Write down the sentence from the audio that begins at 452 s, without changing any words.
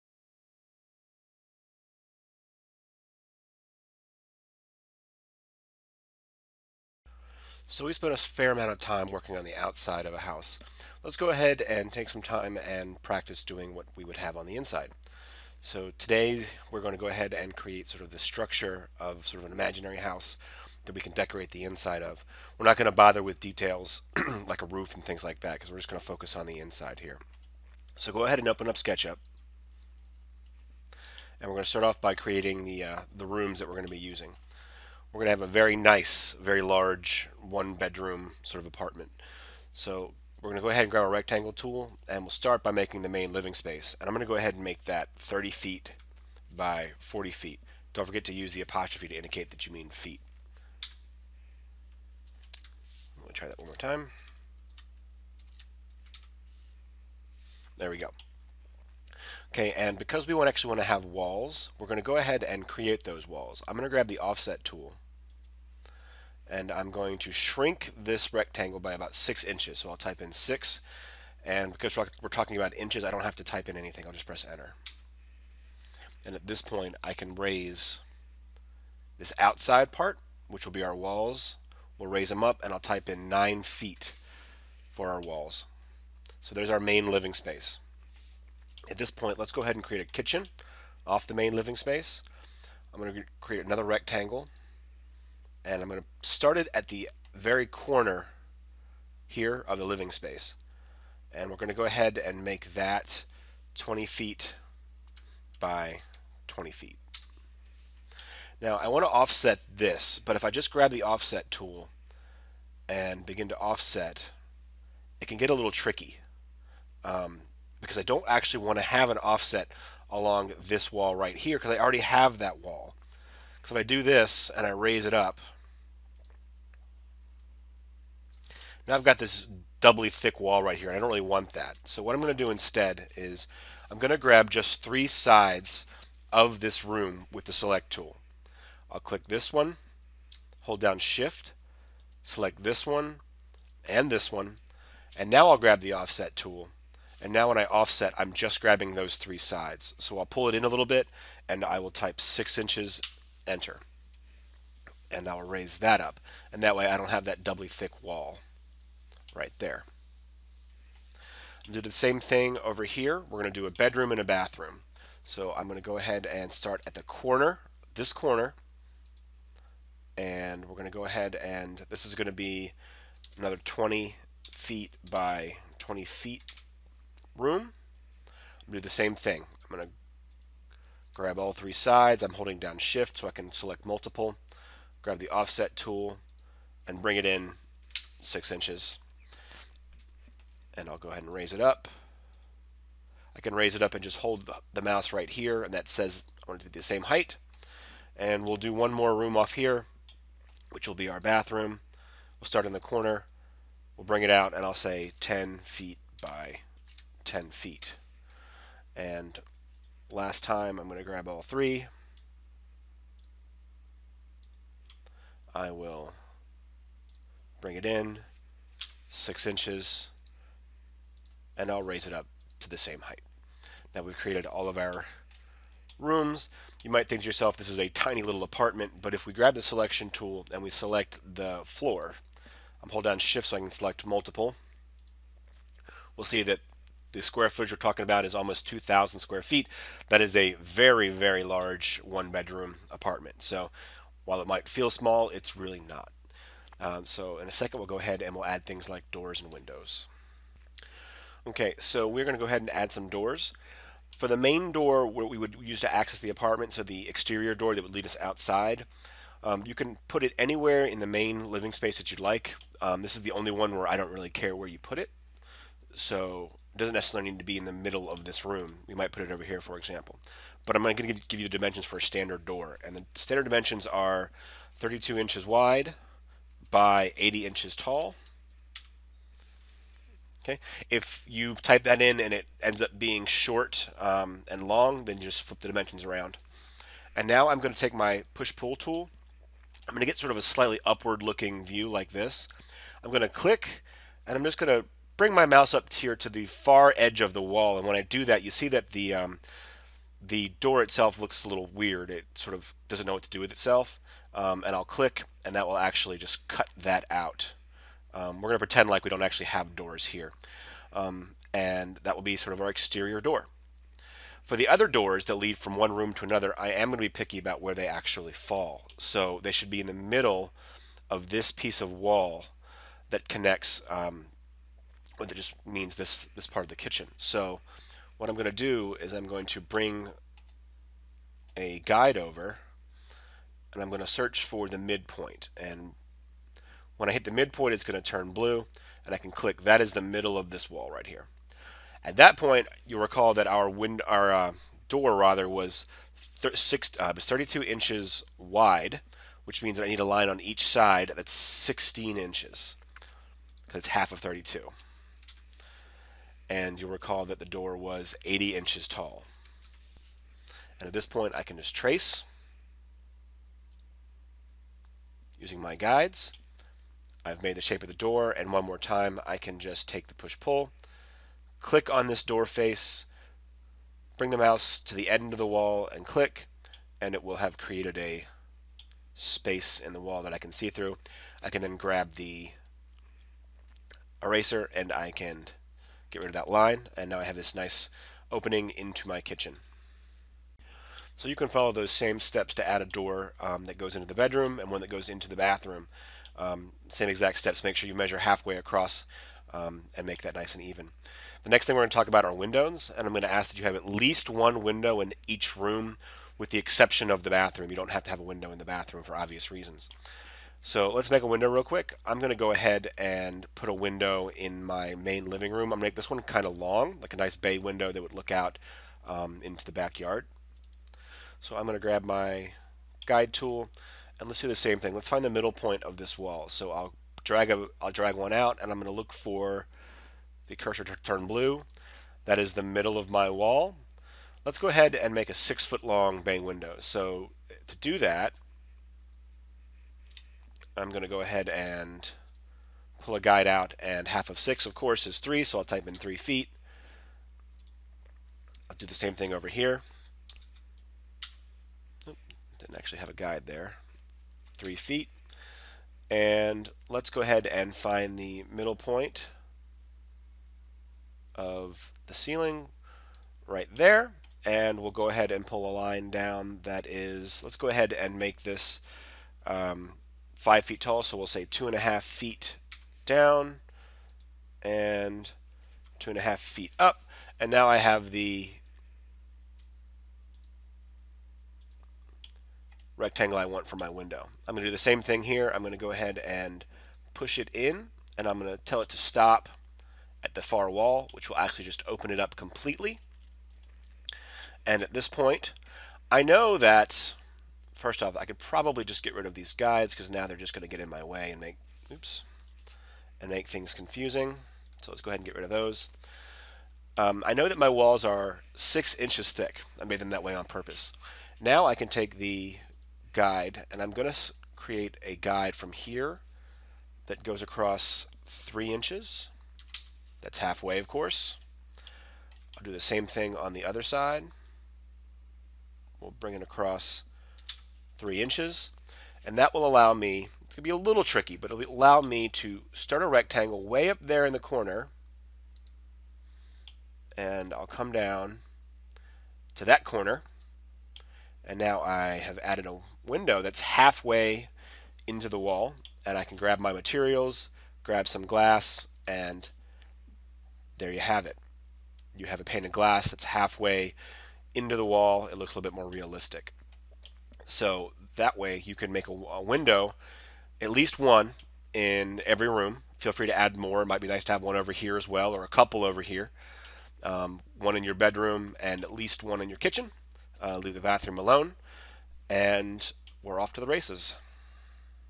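Oop, didn't actually have a guide there.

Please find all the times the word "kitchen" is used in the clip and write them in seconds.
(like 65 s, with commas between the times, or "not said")
90 s, 326 s, 389 s, 569 s.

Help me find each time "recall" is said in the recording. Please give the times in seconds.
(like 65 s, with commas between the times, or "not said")
343 s, 356 s.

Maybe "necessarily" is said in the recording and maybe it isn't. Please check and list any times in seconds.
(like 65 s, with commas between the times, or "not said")
266 s.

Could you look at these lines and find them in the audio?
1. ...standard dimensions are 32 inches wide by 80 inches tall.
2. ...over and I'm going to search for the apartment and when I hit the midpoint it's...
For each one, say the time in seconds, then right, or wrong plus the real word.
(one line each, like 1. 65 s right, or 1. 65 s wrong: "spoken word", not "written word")
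1. 273 s right
2. 332 s wrong: "midpoint", not "apartment".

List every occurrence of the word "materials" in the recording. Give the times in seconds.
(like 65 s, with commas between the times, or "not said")
546 s.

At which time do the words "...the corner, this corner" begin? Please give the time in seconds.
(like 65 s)
166 s.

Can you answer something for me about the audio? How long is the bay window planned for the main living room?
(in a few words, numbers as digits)
6 feet.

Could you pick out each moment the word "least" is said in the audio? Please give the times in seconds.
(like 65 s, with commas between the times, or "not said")
403 s, 560 s, 568 s.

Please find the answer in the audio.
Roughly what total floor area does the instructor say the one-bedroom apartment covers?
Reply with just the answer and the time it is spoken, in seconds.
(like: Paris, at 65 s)
almost 2,000 square feet, at 238 s.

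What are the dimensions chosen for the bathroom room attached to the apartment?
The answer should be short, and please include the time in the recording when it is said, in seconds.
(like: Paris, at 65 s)
10 feet by 10 feet, at 205 s.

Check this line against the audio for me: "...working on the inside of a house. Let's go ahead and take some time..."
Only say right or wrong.
wrong.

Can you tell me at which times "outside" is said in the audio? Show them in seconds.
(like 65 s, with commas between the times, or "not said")
9 s, 79 s, 258 s.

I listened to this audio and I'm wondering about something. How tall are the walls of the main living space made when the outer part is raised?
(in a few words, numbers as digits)
9 feet.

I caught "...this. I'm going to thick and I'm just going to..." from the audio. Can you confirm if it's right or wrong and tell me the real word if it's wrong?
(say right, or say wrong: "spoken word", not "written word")
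wrong: "click", not "thick".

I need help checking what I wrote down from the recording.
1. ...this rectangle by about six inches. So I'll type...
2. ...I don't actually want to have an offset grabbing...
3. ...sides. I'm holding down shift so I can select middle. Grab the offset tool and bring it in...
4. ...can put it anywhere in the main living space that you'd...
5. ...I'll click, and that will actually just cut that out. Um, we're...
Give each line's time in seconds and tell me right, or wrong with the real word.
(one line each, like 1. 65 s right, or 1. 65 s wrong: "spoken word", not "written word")
1. 67 s right
2. 117 s wrong: "along", not "grabbing"
3. 181 s wrong: "multiple", not "middle"
4. 259 s right
5. 304 s right.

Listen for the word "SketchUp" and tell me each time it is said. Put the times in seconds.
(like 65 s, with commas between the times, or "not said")
28 s.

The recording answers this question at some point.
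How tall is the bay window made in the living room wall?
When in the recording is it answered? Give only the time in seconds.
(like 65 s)
470 s.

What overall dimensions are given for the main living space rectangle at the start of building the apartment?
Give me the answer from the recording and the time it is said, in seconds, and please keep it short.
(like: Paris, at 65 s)
30 feet by 40 feet, at 45 s.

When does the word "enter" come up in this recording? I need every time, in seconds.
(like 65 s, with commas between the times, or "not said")
74 s, 153 s.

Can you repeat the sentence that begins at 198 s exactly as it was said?
And we'll do one more room off here, which will be our bathroom.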